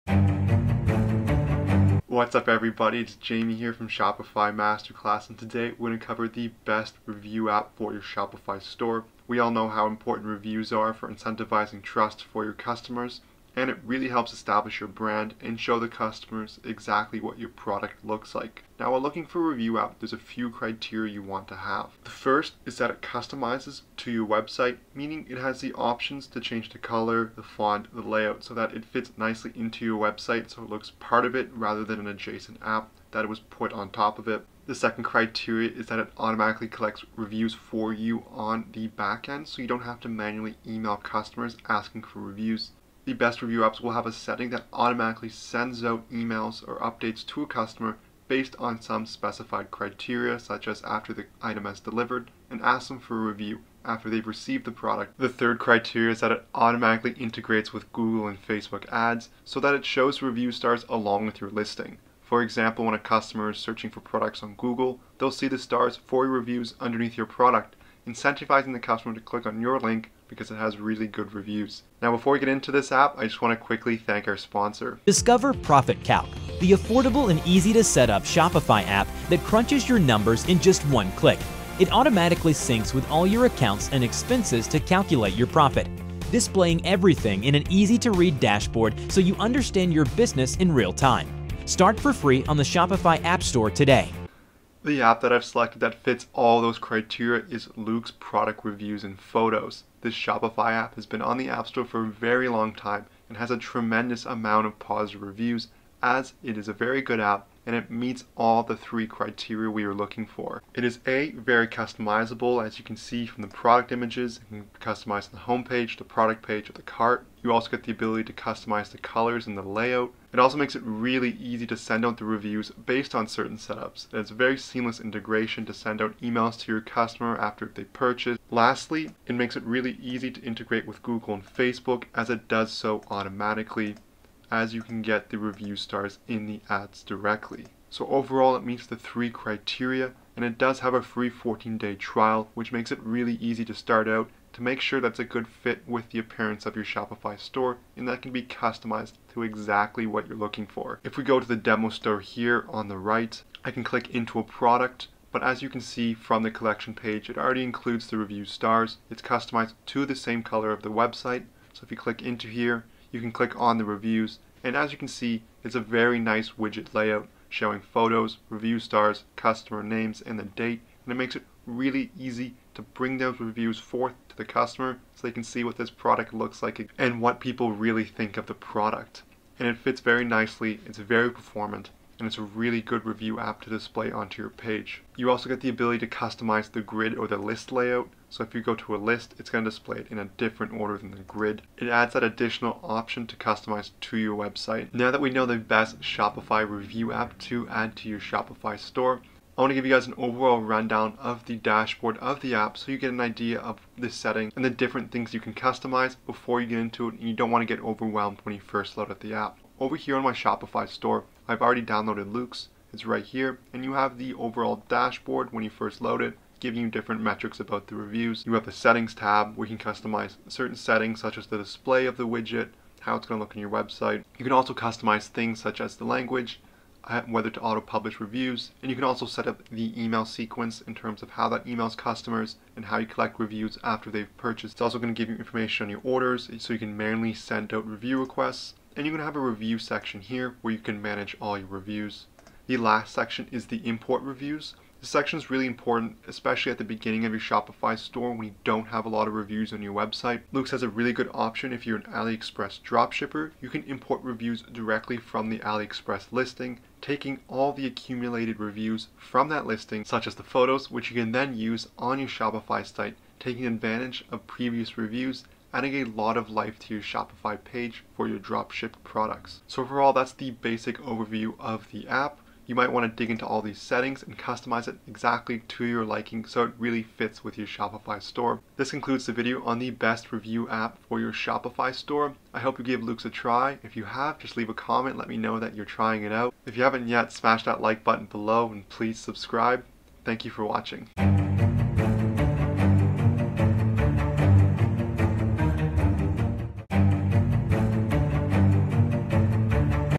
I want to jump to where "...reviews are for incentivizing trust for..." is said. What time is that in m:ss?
0:10.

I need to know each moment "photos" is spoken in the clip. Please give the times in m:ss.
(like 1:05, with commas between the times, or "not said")
1:39, 2:47, 4:20.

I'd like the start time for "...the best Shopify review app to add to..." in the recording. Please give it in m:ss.
3:15.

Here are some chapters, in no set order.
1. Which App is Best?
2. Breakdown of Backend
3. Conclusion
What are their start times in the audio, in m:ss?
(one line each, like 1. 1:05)
1. 1:51
2. 3:15
3. 4:38.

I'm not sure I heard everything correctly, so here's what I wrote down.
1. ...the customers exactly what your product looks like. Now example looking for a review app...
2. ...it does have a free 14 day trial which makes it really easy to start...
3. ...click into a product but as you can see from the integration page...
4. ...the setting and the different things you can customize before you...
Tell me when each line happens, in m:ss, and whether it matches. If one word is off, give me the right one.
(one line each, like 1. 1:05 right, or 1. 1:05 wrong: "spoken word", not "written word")
1. 0:15 wrong: "while", not "example"
2. 2:20 right
3. 2:33 wrong: "collection", not "integration"
4. 3:23 right.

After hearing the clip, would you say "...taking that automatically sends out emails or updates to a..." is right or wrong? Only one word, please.
wrong.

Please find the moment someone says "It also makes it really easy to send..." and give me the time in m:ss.
2:00.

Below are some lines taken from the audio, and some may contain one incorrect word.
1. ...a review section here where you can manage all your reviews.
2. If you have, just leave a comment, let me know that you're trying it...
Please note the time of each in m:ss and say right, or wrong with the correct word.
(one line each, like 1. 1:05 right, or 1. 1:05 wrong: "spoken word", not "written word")
1. 3:59 right
2. 4:43 right.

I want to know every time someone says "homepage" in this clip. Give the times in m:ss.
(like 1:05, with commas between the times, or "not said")
1:55.